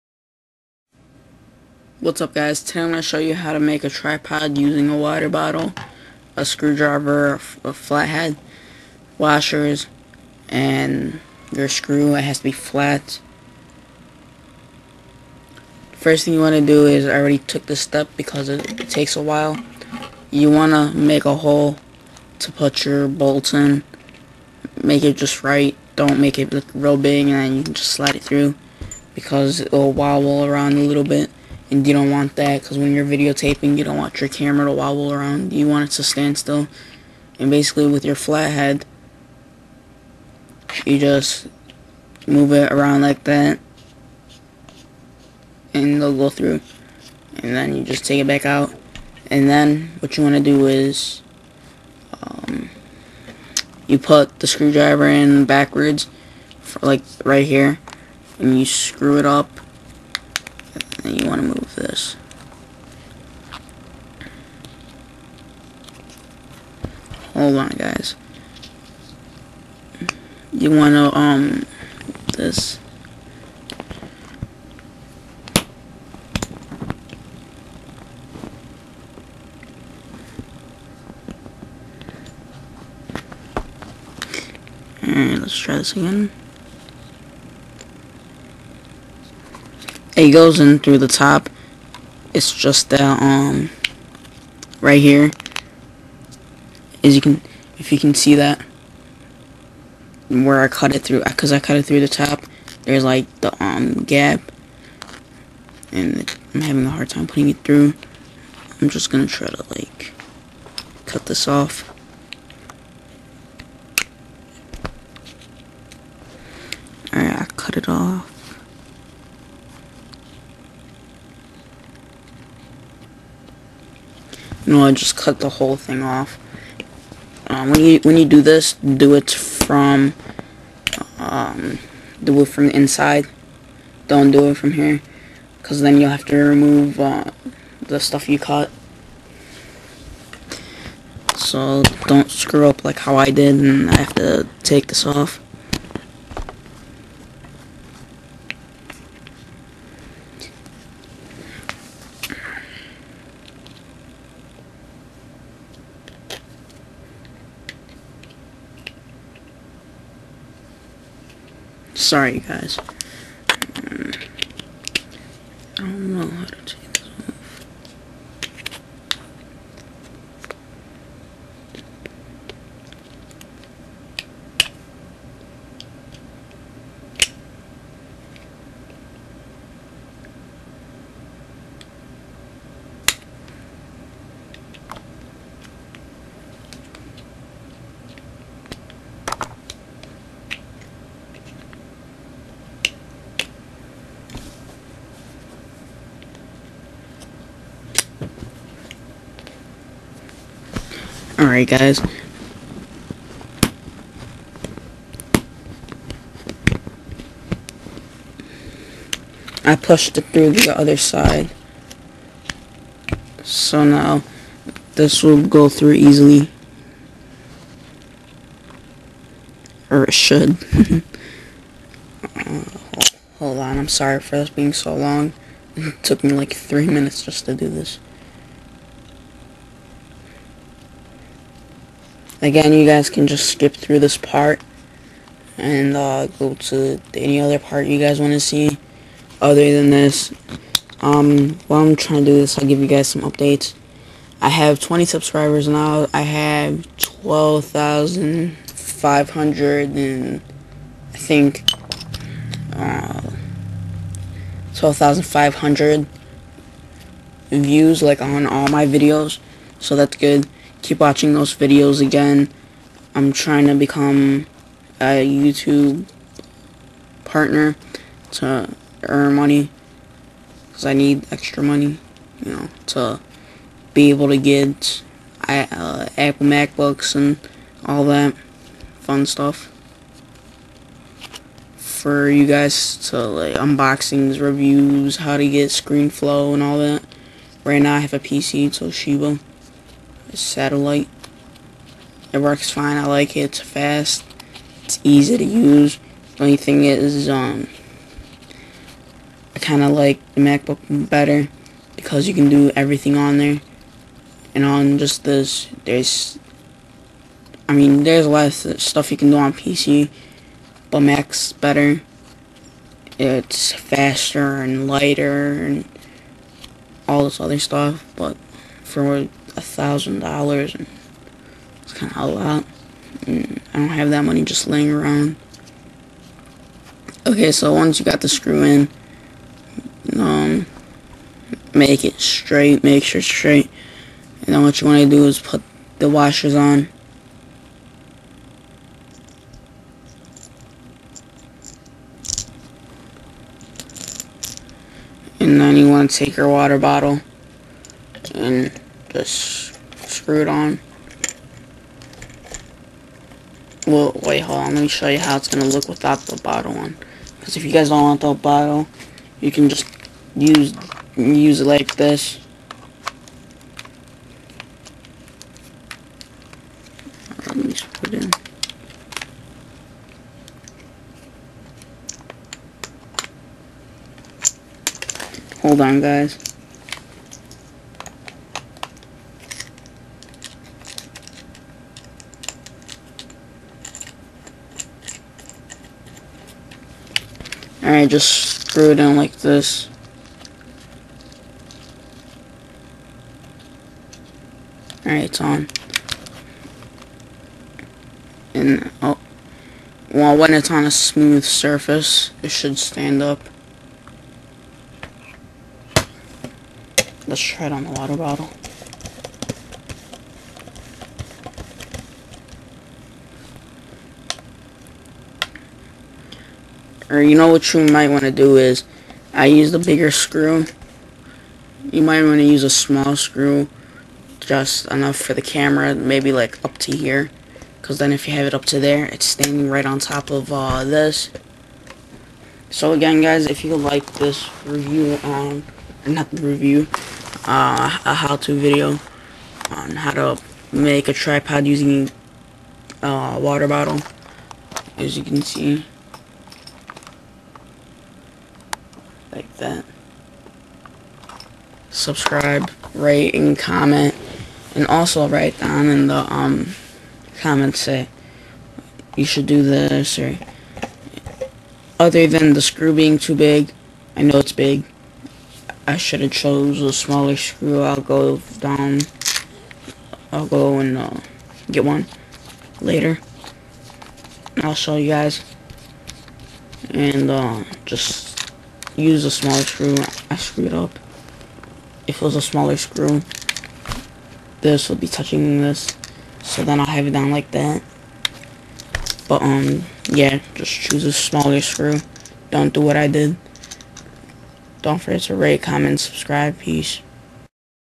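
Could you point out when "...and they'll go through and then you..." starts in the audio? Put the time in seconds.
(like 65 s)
45 s.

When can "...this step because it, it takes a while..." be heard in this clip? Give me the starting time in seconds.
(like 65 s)
17 s.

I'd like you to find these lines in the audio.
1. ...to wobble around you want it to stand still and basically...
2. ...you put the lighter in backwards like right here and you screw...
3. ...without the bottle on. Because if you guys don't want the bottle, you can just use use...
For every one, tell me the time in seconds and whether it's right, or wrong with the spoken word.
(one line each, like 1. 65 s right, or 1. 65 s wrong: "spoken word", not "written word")
1. 34 s right
2. 53 s wrong: "screwdriver", not "lighter"
3. 355 s right.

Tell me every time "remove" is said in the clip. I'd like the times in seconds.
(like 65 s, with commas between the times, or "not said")
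136 s.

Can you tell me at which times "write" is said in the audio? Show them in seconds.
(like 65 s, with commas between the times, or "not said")
455 s.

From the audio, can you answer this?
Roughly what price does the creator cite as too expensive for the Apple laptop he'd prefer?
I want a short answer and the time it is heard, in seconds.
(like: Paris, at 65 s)
$1,000, at 319 s.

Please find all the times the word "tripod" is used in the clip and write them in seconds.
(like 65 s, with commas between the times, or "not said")
3 s, 441 s.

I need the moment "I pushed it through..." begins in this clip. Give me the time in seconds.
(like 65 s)
209 s.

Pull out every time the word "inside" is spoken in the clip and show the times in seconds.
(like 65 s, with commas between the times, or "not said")
132 s.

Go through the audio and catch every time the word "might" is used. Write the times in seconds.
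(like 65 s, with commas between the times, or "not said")
417 s, 422 s.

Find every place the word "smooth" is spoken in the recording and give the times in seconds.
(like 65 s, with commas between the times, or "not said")
400 s.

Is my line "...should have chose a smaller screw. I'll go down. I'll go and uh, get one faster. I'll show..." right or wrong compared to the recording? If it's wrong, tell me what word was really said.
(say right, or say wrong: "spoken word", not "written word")
wrong: "later", not "faster".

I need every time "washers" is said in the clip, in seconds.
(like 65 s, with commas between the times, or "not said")
9 s, 336 s.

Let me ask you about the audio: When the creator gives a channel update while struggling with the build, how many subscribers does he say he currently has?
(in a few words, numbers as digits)
20.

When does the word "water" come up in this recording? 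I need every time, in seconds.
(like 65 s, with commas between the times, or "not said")
4 s, 346 s, 407 s, 443 s.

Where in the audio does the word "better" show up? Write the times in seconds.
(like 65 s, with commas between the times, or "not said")
301 s, 311 s.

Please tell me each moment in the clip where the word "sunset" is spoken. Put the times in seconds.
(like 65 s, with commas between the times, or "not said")
not said.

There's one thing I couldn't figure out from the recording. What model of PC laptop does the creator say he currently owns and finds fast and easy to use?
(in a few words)
Toshiba Satellite.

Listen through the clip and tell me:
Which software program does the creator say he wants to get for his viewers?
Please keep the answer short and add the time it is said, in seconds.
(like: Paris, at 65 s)
ScreenFlow, at 285 s.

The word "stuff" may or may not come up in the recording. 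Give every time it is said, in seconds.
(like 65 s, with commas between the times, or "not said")
137 s, 279 s, 308 s, 317 s.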